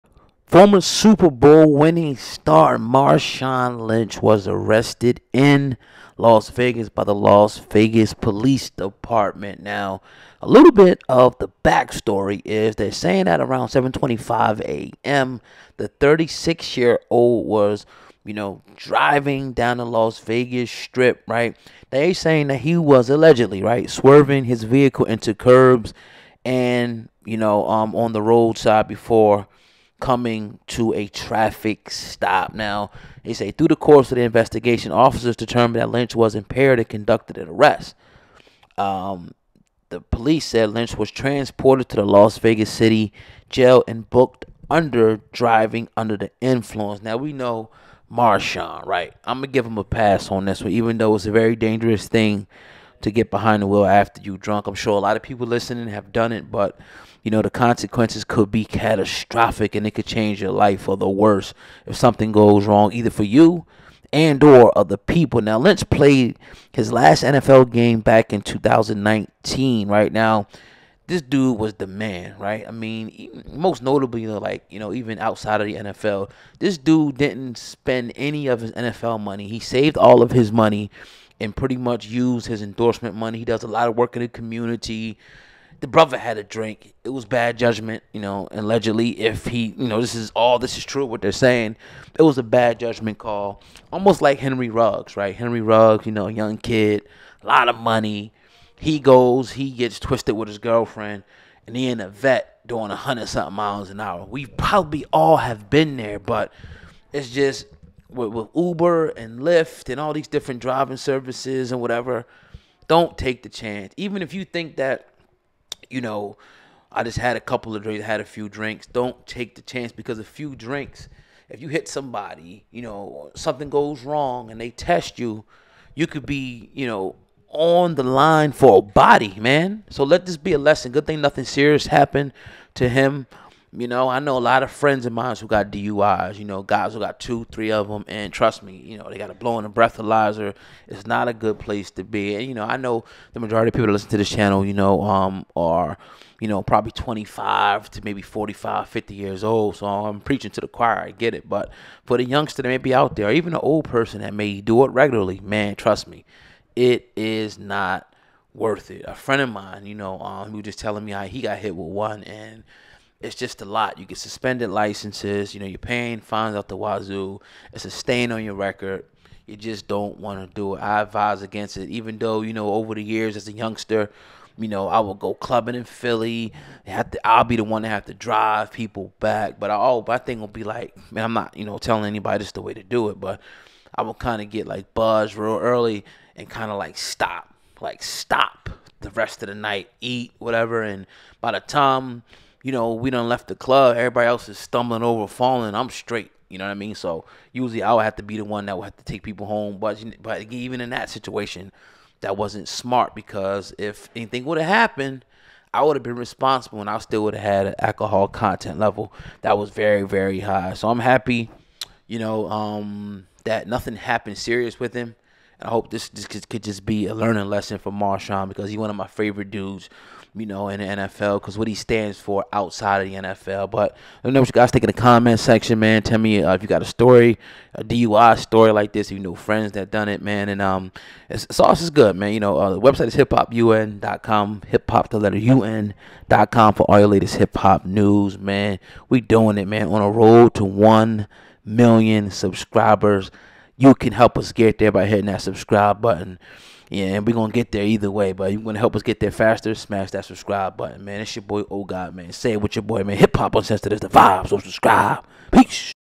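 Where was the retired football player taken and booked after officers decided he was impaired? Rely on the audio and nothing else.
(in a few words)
Las Vegas City jail.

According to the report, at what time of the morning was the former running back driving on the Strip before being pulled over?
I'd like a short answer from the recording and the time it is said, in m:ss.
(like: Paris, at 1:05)
7:25 a.m., at 0:13.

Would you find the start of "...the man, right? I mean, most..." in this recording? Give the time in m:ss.
1:11.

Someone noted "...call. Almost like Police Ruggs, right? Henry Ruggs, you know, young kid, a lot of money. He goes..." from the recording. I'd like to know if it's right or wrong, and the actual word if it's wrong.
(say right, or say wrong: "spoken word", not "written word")
wrong: "Henry", not "Police".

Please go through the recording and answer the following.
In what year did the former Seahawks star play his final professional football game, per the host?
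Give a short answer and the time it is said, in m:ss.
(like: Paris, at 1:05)
2019, at 1:08.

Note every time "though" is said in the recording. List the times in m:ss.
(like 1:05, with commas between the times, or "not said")
0:50, 2:52.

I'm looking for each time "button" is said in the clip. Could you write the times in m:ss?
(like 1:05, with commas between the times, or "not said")
4:06, 4:10.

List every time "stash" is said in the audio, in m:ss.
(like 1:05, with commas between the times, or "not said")
not said.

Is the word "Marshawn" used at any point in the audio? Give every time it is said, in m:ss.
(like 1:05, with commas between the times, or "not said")
0:02, 0:48, 3:37.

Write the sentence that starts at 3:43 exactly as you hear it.
But let me know what you guys think in the comment section, man.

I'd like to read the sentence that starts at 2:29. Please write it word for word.
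So I'm preaching to the choir.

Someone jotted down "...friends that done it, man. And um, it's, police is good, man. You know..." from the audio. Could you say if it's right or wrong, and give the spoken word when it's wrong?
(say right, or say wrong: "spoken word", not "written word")
wrong: "sauce", not "police".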